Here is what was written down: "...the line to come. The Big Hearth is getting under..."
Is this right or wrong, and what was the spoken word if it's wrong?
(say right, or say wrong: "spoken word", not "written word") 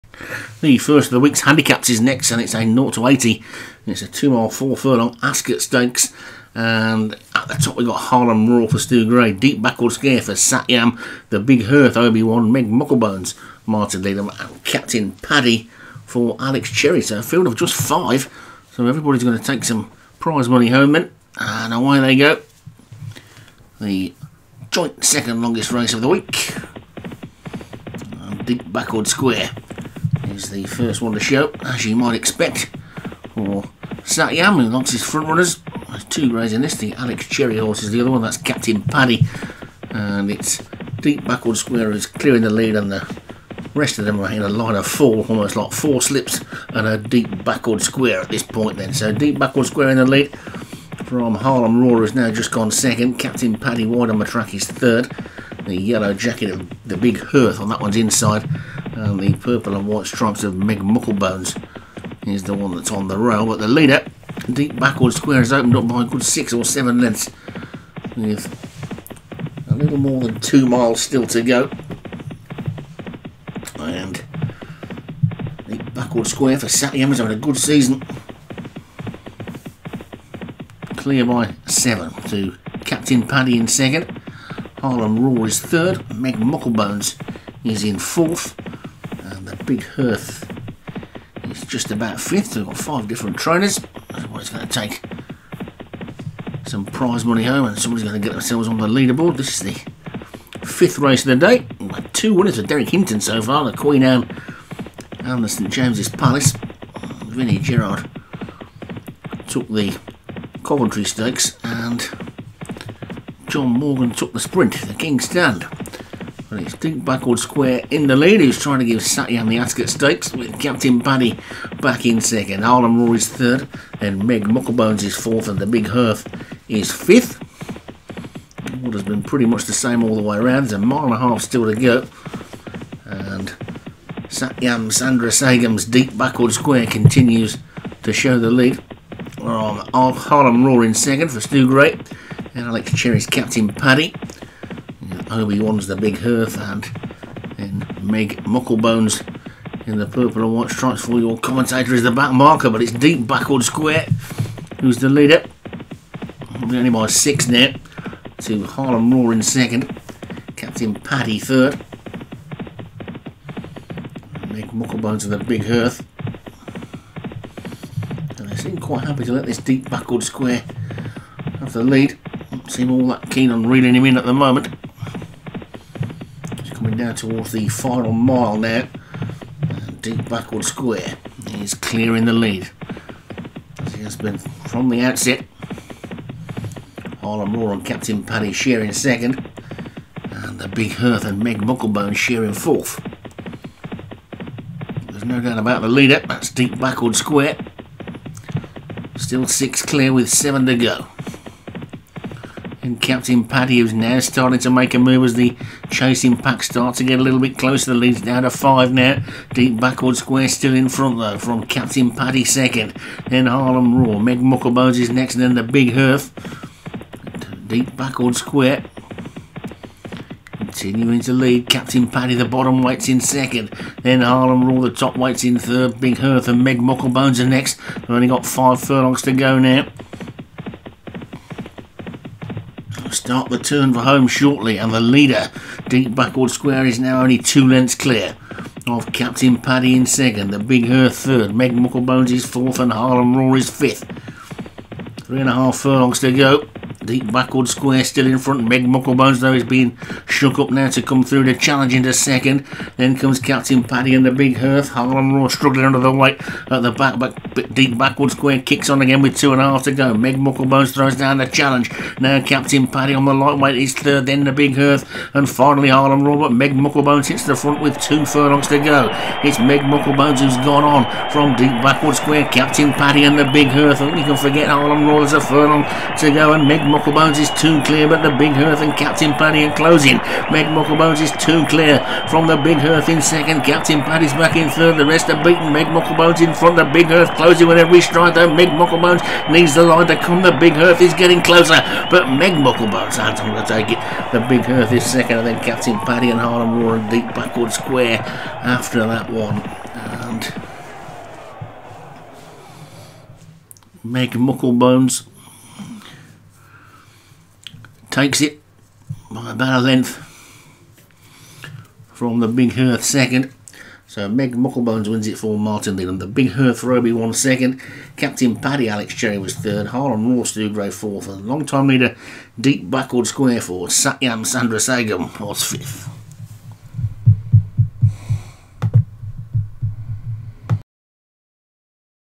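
wrong: "closer", not "under".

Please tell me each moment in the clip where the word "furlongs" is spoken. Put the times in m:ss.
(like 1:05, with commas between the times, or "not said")
0:04, 3:48, 4:05, 4:28, 4:35.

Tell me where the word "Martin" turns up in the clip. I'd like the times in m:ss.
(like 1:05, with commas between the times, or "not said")
0:13, 5:15.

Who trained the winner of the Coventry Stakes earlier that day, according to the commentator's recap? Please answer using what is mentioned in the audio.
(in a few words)
Vinnie Gerard.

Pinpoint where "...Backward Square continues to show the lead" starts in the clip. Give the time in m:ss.
2:16.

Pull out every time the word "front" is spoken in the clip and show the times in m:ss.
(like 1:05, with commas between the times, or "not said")
0:35, 3:30, 4:08, 4:27, 4:46.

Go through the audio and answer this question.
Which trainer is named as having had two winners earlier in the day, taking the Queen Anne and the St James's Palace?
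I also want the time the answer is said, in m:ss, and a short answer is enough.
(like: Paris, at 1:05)
Derek Hinton, at 1:42.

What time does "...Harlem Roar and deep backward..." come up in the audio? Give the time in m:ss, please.
4:56.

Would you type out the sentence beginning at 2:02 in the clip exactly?
Harlem Rory's is third, and Meg Mucklebones is fourth, and the Big Hearth is fifth.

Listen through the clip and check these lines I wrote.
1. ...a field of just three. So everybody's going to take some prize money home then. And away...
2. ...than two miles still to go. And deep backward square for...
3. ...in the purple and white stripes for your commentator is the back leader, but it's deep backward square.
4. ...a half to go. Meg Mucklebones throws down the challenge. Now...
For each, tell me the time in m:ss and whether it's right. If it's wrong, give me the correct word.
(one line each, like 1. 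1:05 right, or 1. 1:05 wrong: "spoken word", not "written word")
1. 0:17 wrong: "five", not "three"
2. 1:10 right
3. 2:29 wrong: "marker", not "leader"
4. 4:19 right.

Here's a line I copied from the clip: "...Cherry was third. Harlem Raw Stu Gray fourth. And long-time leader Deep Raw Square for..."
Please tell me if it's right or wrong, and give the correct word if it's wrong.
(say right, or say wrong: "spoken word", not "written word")
wrong: "Backward", not "Raw".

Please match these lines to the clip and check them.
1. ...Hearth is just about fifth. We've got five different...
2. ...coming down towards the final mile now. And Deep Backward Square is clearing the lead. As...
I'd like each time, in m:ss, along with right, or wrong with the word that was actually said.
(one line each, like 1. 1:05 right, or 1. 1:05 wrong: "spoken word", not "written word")
1. 1:29 right
2. 2:56 right.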